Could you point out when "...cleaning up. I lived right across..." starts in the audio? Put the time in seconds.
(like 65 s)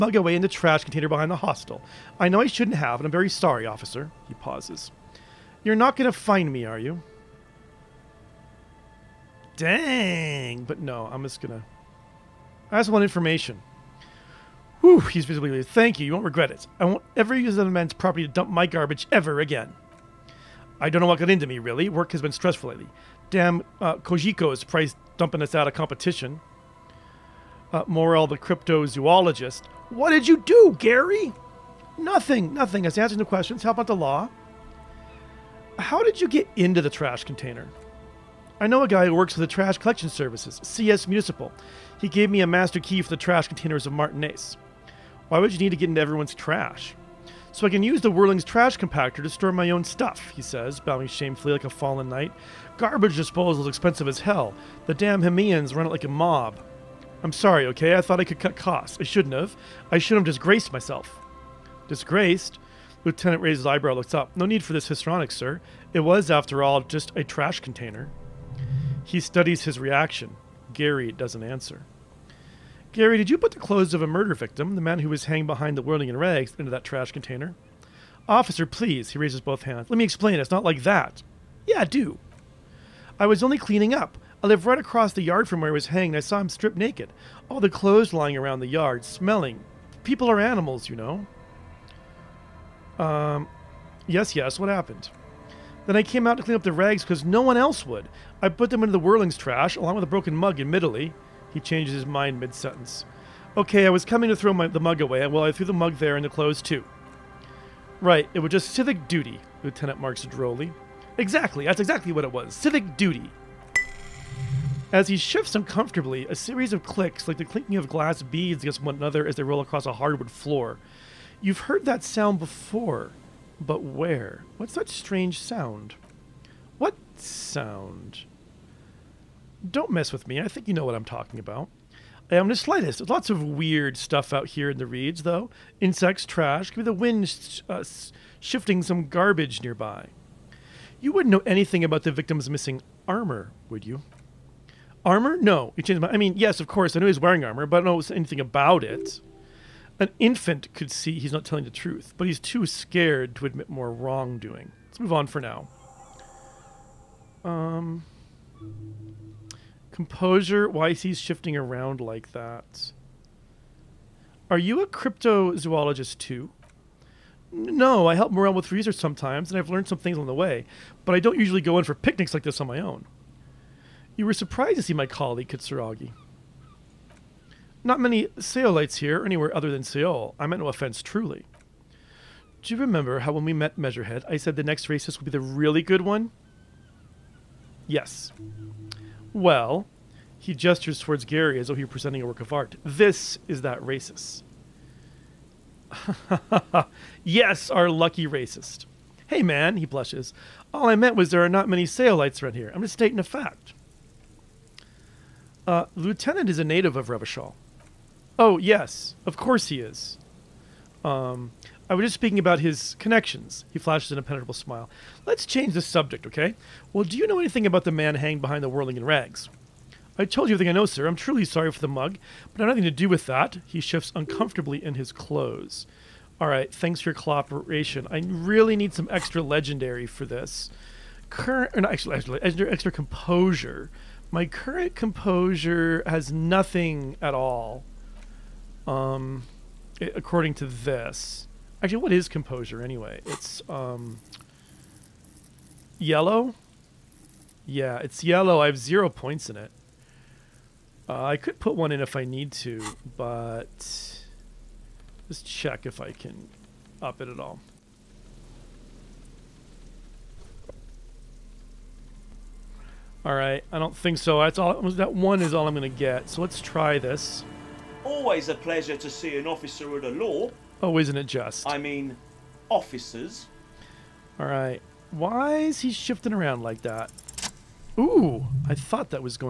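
83 s.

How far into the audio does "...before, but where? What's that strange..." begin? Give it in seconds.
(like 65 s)
122 s.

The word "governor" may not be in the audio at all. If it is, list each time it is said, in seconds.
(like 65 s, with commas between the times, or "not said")
not said.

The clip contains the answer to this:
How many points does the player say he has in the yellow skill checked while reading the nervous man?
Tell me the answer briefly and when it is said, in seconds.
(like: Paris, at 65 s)
0, at 248 s.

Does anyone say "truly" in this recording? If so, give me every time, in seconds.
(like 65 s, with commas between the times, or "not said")
181 s, 221 s.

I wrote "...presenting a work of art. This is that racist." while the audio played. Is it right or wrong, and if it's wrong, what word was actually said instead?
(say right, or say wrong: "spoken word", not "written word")
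right.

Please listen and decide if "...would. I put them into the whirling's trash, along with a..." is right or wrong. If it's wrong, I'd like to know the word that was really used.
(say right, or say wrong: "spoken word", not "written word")
right.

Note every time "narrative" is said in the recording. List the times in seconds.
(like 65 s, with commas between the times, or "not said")
not said.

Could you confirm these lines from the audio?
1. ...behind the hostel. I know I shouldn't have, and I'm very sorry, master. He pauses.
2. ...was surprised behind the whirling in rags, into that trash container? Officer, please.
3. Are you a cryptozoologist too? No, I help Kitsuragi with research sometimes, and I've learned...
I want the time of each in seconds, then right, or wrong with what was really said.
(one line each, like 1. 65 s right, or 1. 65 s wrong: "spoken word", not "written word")
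1. 1 s wrong: "officer", not "master"
2. 75 s wrong: "hanged", not "surprised"
3. 164 s wrong: "Morell", not "Kitsuragi".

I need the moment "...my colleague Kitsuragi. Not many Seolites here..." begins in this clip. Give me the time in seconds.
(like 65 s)
174 s.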